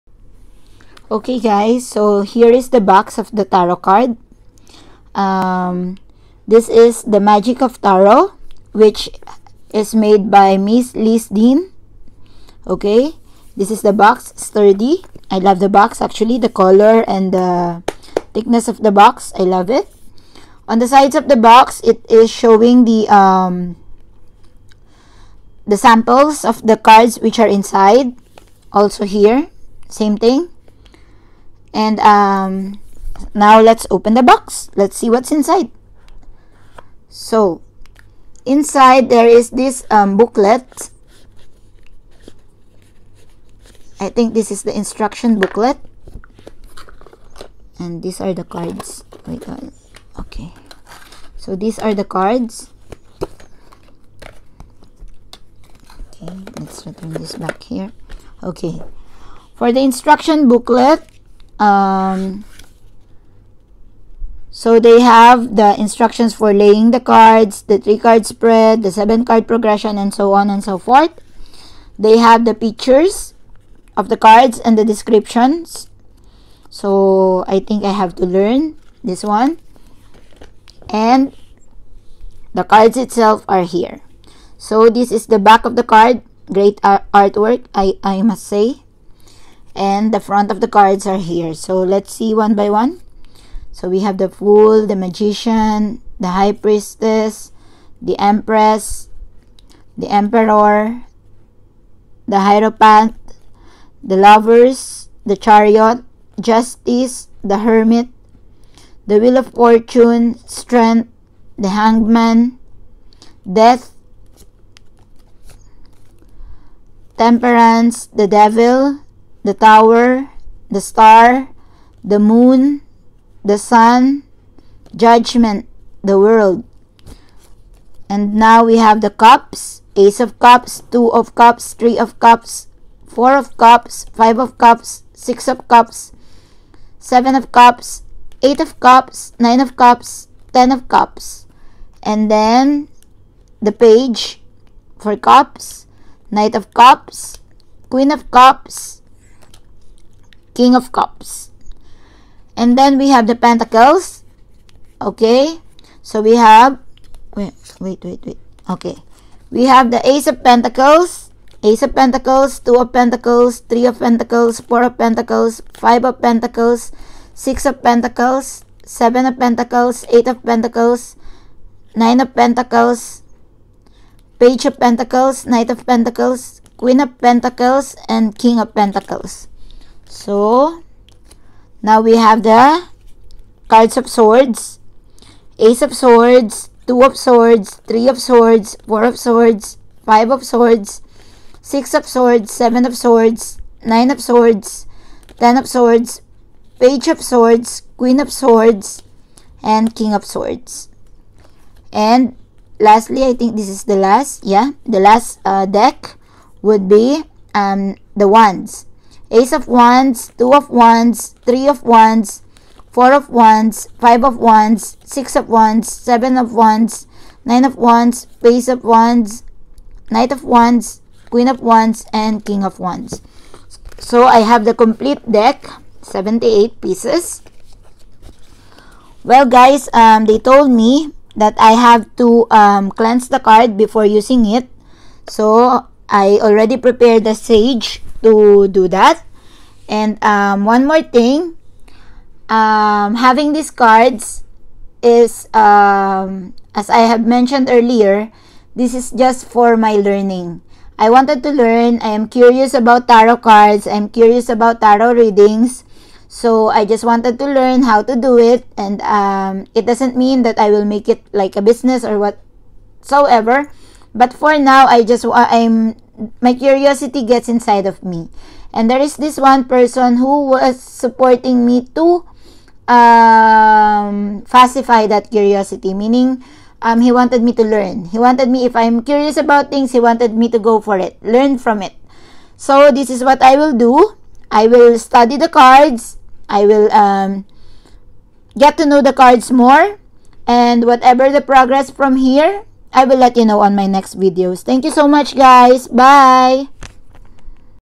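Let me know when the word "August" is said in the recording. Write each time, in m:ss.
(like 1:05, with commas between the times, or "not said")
not said.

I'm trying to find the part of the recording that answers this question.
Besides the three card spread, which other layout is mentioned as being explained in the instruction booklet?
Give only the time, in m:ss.
1:08.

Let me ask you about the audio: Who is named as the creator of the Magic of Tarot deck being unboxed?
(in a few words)
Liz Dean.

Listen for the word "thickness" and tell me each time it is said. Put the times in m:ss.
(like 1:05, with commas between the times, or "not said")
0:18.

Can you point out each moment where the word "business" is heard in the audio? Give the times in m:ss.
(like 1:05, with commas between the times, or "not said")
4:21.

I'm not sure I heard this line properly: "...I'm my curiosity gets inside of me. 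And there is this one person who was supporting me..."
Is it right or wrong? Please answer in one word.
right.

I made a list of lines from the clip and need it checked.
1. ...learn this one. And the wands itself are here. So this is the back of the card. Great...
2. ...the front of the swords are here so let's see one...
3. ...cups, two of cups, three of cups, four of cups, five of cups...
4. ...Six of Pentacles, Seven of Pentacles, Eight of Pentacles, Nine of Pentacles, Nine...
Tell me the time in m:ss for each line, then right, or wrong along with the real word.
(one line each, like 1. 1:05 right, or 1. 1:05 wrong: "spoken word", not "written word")
1. 1:18 wrong: "cards", not "wands"
2. 1:30 wrong: "cards", not "swords"
3. 2:10 right
4. 2:47 wrong: "Page", not "Nine".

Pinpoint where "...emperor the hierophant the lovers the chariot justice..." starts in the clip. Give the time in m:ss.
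1:40.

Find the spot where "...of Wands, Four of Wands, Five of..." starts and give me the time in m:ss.
3:31.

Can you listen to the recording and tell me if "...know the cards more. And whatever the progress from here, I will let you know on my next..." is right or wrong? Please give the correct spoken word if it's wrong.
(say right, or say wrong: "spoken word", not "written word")
right.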